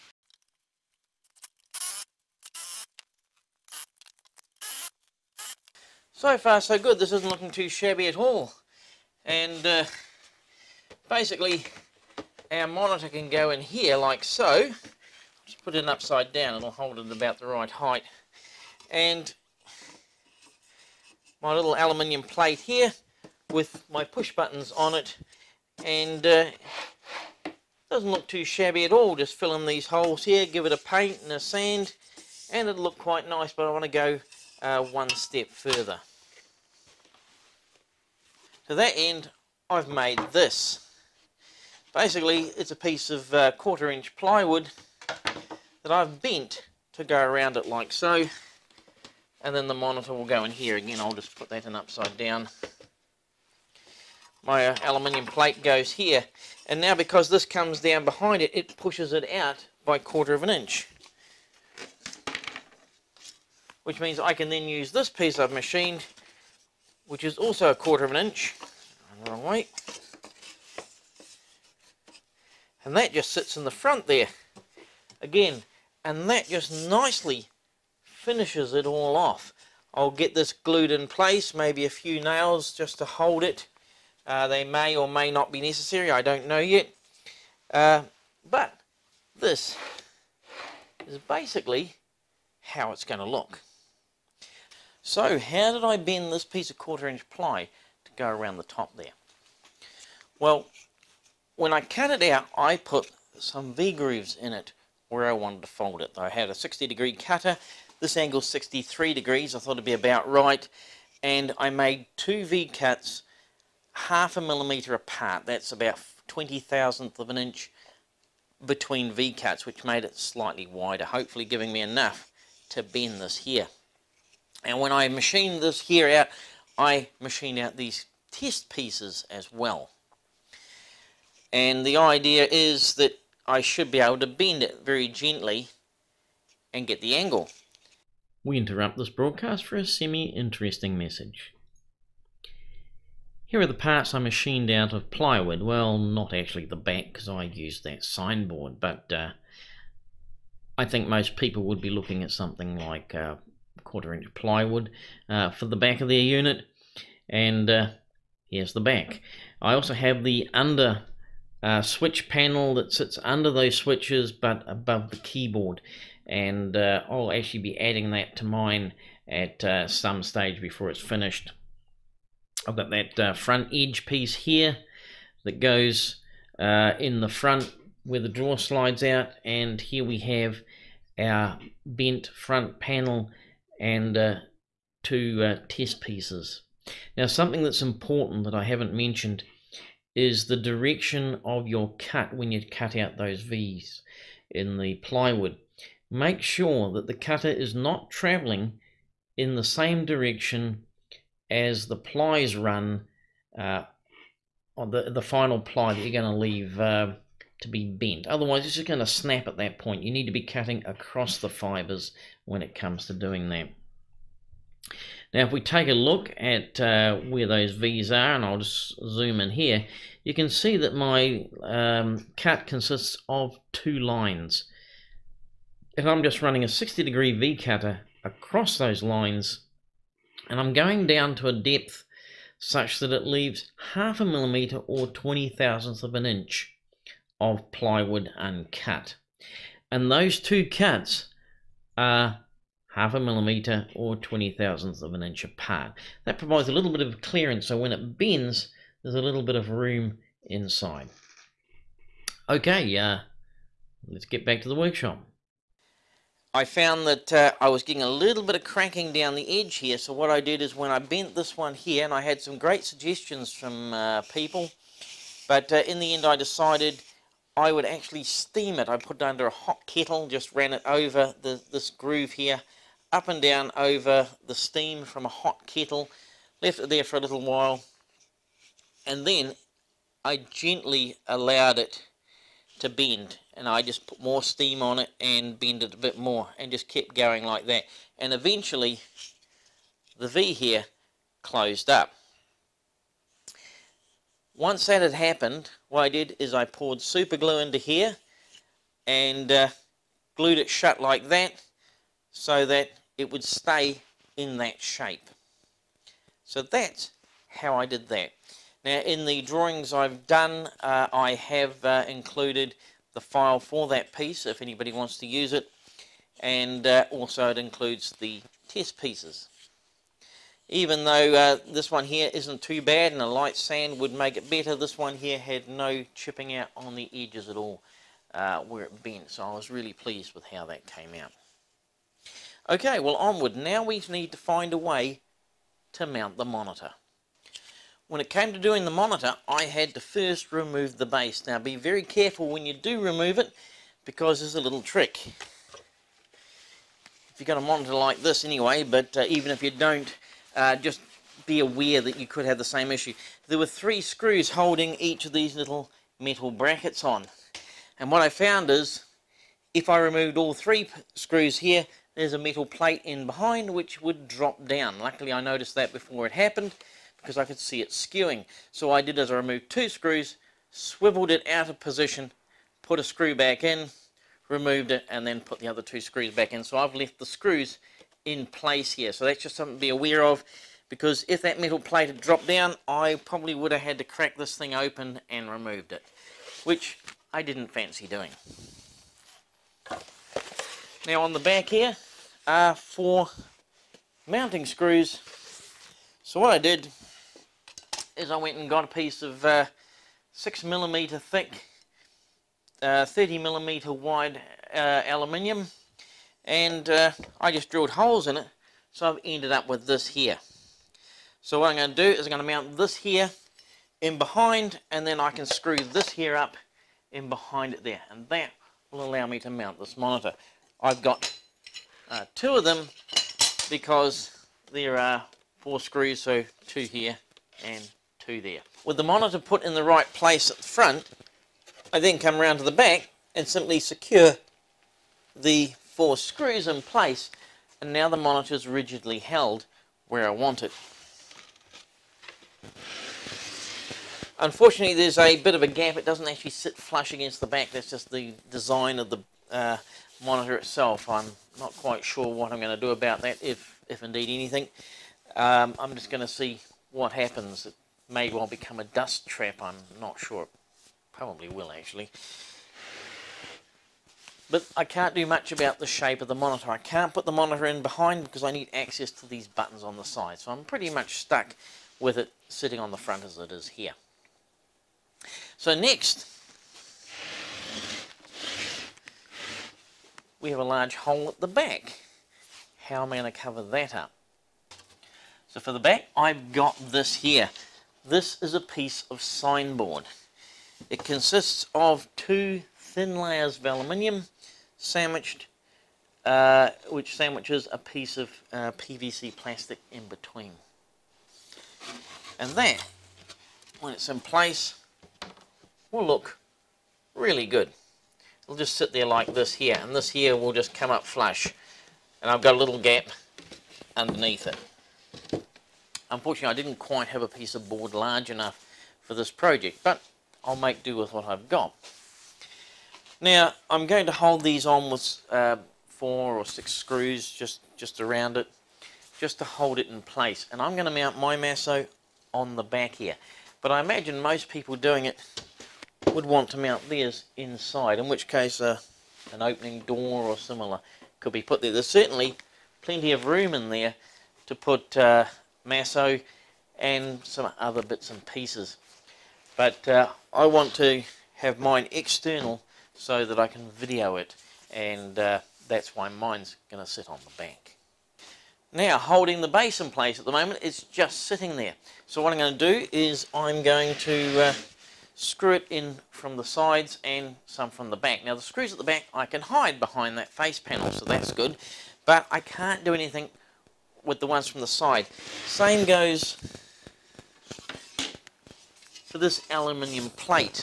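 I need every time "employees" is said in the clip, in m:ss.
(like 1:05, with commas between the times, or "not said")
not said.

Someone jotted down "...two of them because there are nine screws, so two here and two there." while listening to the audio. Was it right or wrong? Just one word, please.
wrong.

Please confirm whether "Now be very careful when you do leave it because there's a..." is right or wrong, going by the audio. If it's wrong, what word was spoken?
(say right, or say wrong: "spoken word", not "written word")
wrong: "remove", not "leave".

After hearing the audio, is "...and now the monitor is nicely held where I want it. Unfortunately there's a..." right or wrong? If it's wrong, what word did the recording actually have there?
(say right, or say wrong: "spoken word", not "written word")
wrong: "rigidly", not "nicely".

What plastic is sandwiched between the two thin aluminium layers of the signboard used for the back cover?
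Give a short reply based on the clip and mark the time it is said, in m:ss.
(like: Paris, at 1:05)
PVC, at 8:18.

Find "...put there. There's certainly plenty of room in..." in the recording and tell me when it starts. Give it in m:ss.
9:01.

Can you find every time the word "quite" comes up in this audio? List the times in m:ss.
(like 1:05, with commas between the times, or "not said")
0:32, 7:31, 8:36.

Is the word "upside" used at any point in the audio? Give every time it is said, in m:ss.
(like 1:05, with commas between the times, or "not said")
0:15, 0:51.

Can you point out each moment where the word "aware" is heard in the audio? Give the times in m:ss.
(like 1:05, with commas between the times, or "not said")
5:51, 6:19.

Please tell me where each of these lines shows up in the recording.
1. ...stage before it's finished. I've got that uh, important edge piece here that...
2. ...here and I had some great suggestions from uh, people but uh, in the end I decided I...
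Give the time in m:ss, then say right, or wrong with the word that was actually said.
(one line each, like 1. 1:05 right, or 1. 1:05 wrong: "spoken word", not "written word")
1. 2:50 wrong: "front", not "important"
2. 4:21 right.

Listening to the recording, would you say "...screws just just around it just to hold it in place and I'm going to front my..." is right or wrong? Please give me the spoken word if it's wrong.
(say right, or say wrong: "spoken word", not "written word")
wrong: "mount", not "front".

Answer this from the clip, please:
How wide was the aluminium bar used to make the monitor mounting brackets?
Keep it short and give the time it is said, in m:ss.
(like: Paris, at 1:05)
30 millimeters, at 6:43.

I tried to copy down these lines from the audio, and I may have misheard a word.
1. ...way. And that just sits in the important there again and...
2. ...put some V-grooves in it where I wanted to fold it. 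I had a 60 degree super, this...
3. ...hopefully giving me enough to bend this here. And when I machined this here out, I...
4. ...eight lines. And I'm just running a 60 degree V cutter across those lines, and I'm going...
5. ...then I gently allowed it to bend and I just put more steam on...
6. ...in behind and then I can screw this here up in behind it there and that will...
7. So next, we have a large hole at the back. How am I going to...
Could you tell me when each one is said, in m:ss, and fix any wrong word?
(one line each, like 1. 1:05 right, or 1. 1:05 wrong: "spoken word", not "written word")
1. 1:09 wrong: "front", not "important"
2. 1:42 wrong: "cutter", not "super"
3. 2:01 right
4. 3:43 wrong: "two", not "eight"
5. 4:39 right
6. 6:54 right
7. 7:55 right.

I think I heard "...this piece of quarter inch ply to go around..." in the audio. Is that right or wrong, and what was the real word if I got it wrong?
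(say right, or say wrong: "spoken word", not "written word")
right.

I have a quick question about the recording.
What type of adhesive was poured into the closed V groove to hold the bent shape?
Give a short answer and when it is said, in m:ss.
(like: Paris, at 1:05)
super glue, at 4:57.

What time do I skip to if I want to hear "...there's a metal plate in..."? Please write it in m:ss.
6:02.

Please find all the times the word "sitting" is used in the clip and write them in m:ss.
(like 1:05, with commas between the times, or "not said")
7:52, 9:21.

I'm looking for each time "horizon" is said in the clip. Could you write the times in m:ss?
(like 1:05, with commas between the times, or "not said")
not said.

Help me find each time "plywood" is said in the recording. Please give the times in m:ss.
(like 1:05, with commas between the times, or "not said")
0:44, 2:25, 2:34, 3:14, 3:57.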